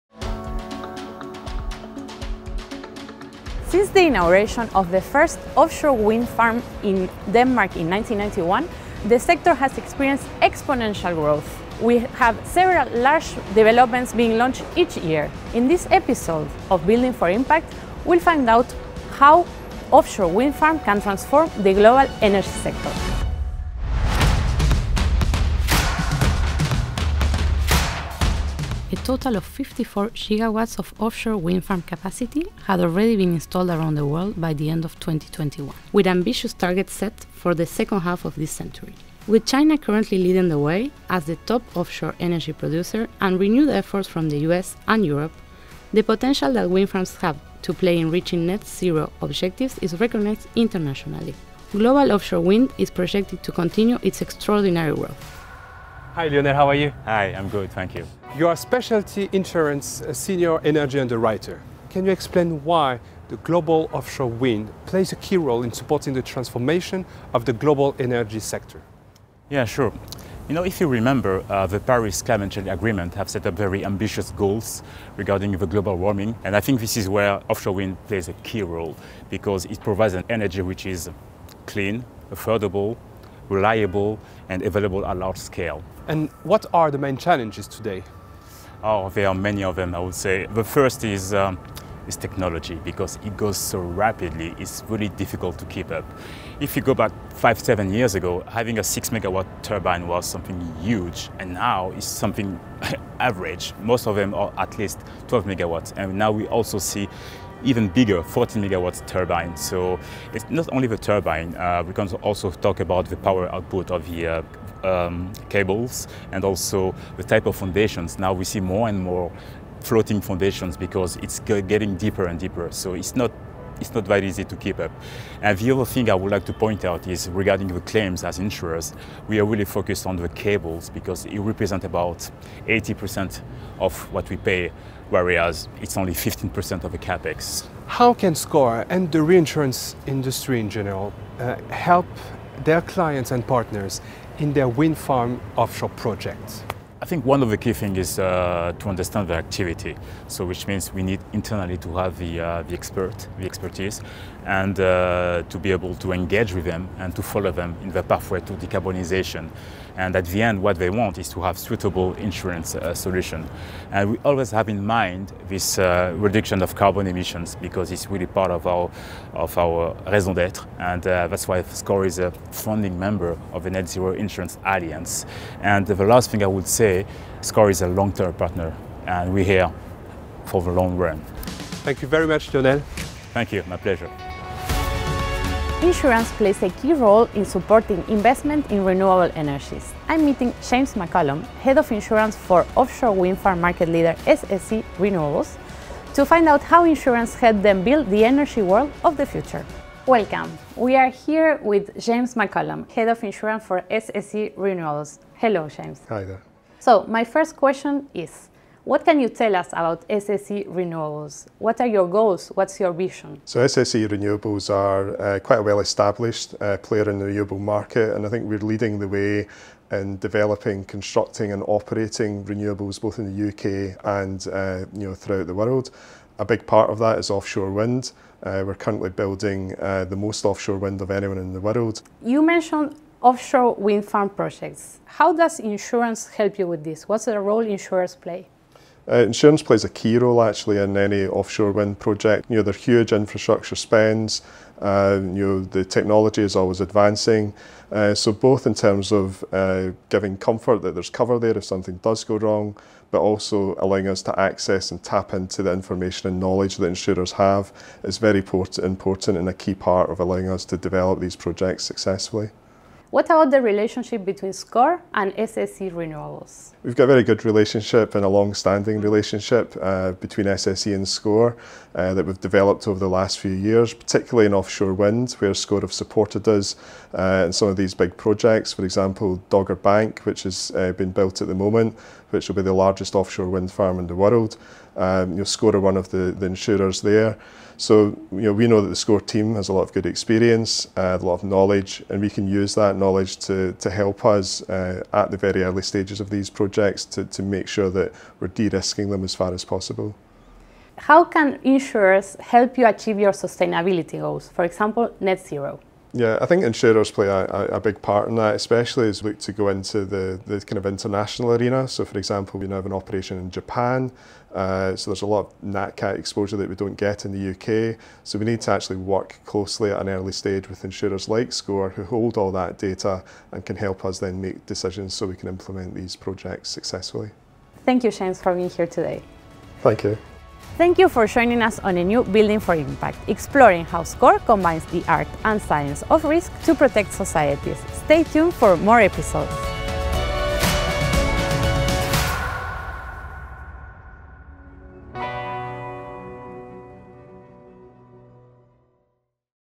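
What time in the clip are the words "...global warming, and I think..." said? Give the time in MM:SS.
01:15.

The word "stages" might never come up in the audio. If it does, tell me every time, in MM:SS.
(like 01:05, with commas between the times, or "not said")
04:55, 05:20.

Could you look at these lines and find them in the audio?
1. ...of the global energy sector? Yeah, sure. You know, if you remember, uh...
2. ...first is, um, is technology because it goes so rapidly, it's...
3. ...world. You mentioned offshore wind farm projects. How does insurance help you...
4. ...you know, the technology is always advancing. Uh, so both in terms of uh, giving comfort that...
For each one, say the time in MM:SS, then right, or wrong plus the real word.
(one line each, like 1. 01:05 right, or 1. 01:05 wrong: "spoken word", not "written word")
1. 01:07 right
2. 01:30 right
3. 03:51 right
4. 04:05 right.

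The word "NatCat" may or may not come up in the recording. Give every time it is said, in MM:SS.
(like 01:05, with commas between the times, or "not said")
05:15.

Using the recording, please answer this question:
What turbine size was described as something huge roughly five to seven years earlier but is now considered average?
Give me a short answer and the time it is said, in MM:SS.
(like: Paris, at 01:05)
6 megawatts, at 01:38.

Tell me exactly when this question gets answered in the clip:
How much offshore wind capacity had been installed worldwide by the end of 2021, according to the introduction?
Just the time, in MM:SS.
00:29.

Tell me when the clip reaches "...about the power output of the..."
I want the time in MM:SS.
01:52.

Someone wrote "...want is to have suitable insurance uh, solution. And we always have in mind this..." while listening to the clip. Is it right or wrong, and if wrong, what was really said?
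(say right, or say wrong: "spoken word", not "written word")
right.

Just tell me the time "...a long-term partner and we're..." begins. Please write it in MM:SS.
02:57.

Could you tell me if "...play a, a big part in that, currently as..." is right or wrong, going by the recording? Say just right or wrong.
wrong.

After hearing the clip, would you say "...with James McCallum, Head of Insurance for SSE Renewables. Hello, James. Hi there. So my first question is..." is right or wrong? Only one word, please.
right.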